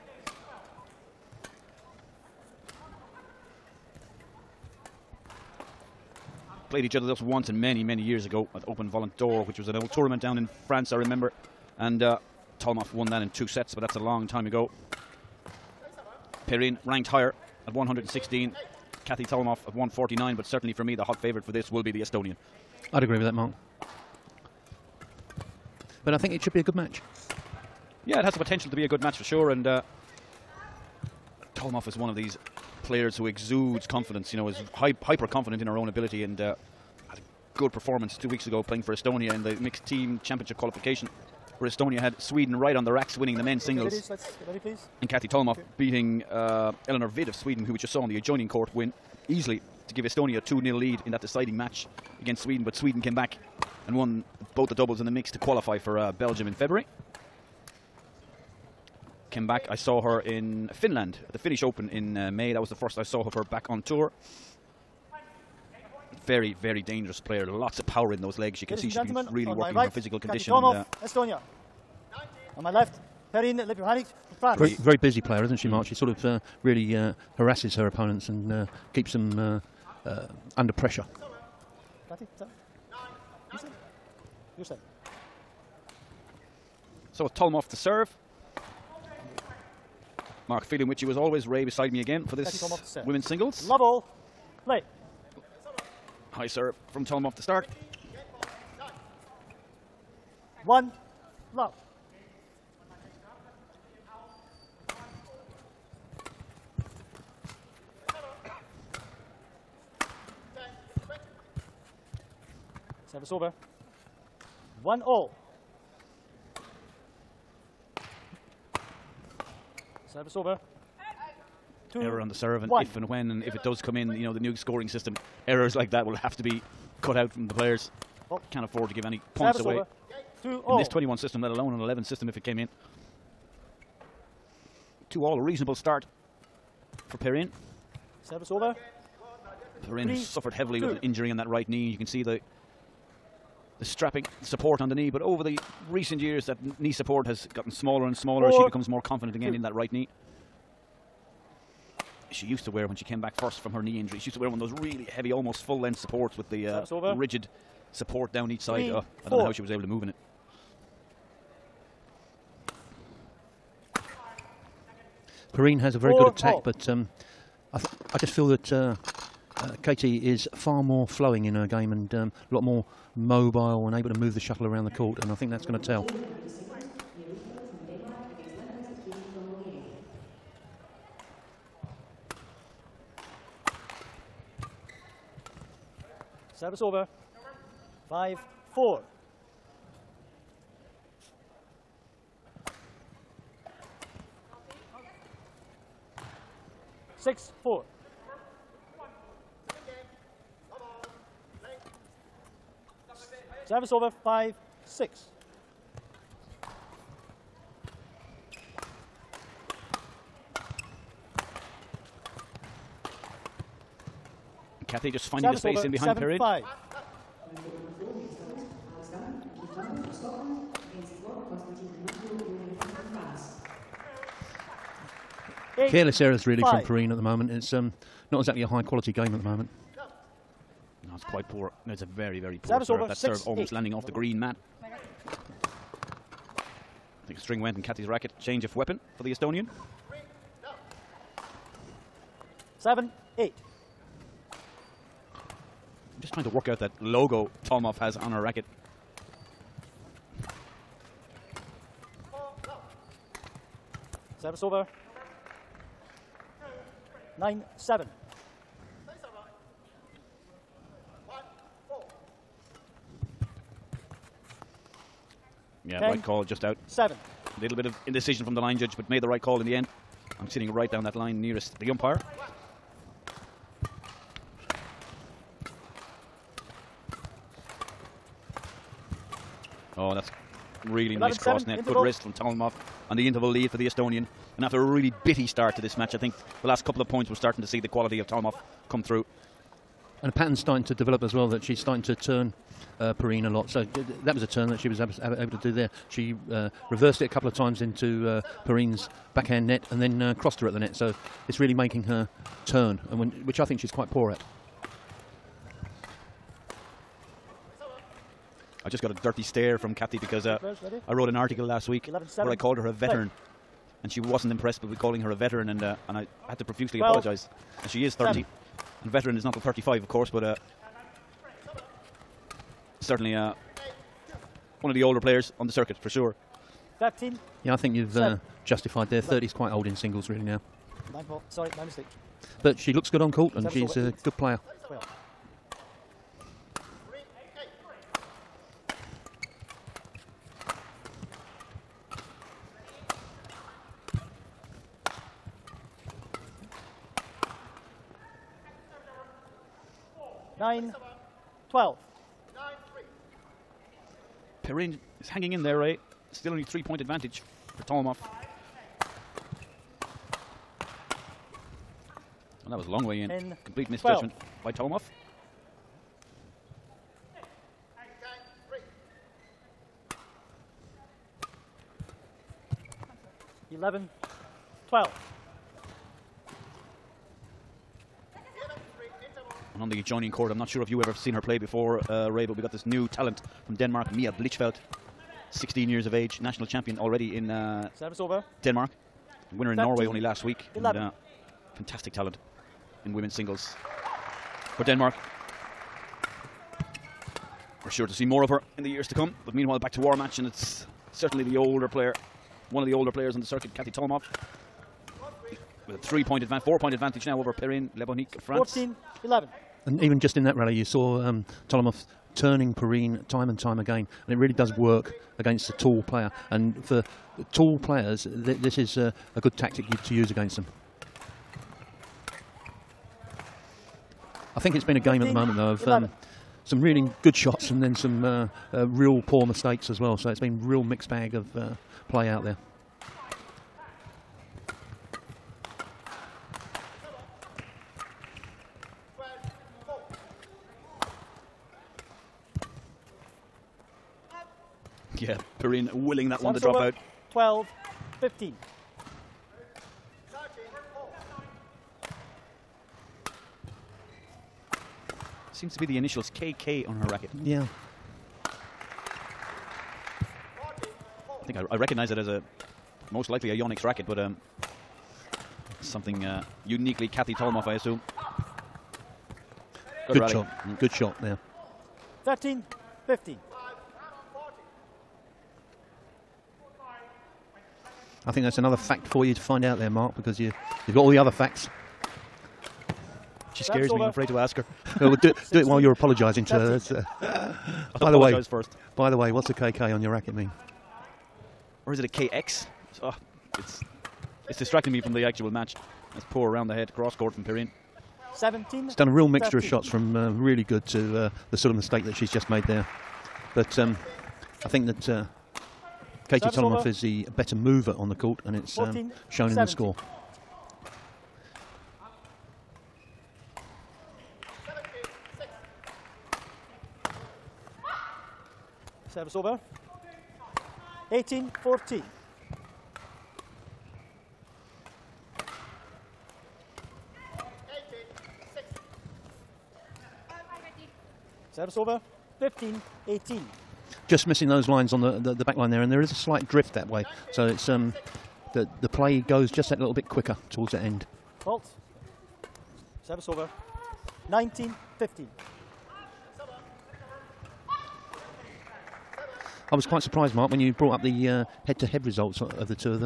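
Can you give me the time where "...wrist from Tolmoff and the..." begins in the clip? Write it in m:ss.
4:42.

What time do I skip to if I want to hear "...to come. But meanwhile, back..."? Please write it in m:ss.
6:39.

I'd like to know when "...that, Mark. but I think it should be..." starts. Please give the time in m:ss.
0:23.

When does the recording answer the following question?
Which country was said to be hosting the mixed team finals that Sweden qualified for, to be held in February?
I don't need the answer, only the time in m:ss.
0:56.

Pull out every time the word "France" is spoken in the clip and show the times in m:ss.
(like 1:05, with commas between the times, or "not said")
0:10, 1:14, 6:48.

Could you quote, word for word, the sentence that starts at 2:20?
with an injury in that right knee.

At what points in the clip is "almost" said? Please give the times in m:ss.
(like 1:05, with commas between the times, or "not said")
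2:35, 3:53.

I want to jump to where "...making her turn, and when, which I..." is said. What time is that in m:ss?
5:01.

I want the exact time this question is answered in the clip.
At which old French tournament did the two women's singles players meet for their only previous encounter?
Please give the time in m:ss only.
0:08.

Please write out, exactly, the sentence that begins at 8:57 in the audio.
So it's um, the, the play goes just that little bit quicker towards the end.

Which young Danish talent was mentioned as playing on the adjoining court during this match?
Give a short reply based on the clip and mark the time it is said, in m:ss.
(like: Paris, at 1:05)
Mia Blichfeldt, at 6:24.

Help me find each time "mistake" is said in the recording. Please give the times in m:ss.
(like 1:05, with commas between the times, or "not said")
5:31, 7:09, 8:21.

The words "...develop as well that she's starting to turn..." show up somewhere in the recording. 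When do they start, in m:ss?
4:50.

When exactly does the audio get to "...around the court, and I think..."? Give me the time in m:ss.
2:54.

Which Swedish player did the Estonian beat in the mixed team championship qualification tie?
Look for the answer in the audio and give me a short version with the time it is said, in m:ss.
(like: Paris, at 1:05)
Ellinor Widh, at 0:46.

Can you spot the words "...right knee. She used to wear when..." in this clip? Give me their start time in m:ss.
2:29.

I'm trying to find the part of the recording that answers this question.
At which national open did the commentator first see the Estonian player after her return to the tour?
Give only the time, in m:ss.
1:01.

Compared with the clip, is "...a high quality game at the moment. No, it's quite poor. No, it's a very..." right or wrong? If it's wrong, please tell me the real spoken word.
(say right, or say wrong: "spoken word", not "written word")
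right.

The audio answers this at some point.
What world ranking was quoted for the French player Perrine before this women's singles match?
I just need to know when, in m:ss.
0:17.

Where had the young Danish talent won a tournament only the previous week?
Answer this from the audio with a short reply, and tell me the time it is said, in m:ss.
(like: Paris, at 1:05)
Norway, at 6:29.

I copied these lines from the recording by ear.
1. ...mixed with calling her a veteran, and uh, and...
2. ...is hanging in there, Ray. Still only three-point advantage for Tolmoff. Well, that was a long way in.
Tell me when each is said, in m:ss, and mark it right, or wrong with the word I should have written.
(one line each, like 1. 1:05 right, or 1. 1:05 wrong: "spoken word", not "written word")
1. 5:14 wrong: "impressed", not "mixed"
2. 5:55 right.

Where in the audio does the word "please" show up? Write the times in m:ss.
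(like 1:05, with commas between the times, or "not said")
0:44.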